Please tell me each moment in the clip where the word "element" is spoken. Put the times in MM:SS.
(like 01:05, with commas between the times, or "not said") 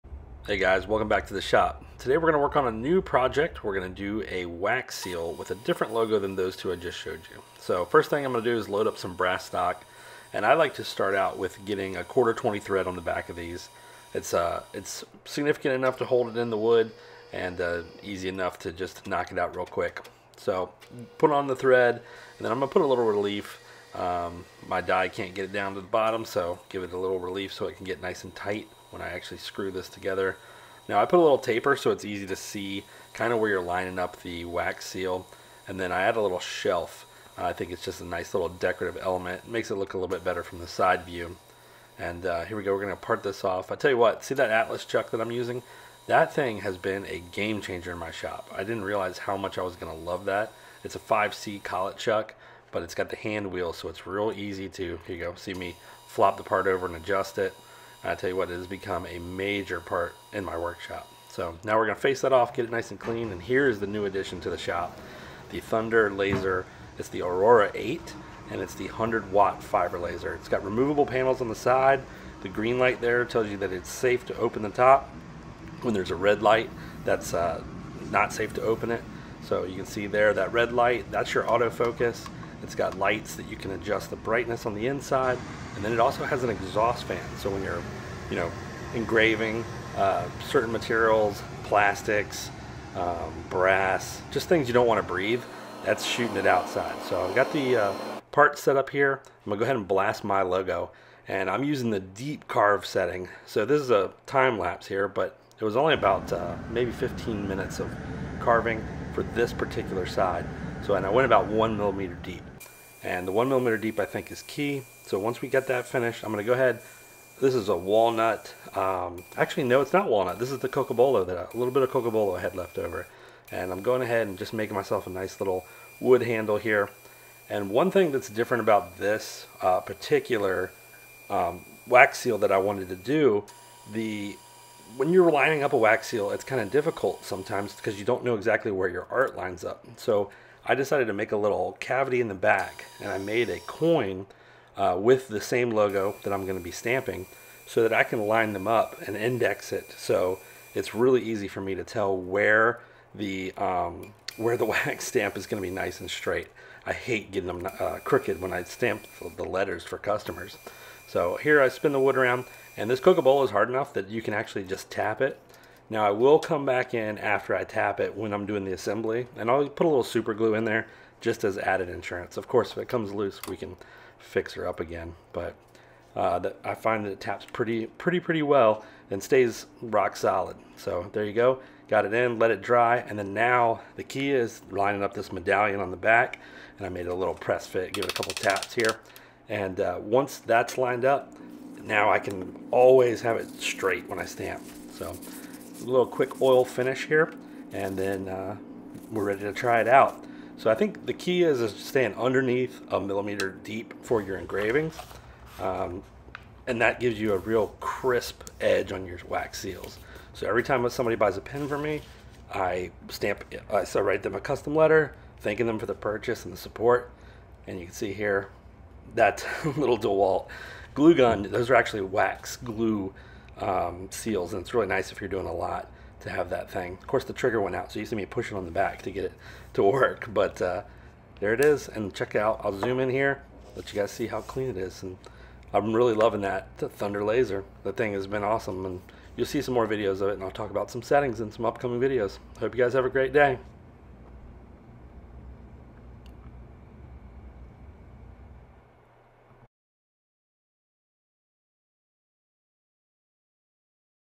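00:39.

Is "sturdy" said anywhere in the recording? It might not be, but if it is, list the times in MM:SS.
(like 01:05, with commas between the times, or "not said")
not said.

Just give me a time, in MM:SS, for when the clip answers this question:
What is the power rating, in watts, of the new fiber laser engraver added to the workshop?
01:08.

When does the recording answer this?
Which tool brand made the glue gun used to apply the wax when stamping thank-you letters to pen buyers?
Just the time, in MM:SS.
03:39.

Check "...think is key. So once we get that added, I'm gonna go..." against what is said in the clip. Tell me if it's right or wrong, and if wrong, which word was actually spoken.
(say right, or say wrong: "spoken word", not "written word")
wrong: "finished", not "added".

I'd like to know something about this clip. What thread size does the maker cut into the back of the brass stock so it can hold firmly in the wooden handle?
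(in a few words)
1/4-20.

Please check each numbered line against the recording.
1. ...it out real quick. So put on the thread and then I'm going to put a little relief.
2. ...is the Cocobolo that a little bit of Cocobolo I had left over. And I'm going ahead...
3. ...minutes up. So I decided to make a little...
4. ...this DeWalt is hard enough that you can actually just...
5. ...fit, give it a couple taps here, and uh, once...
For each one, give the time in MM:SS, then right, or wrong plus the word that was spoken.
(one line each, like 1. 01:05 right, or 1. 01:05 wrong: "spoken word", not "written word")
1. 00:19 right
2. 02:00 right
3. 02:19 wrong: "lines", not "minutes"
4. 02:42 wrong: "Cocobolo", not "DeWalt"
5. 03:07 right.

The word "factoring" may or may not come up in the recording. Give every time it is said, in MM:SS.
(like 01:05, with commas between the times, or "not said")
not said.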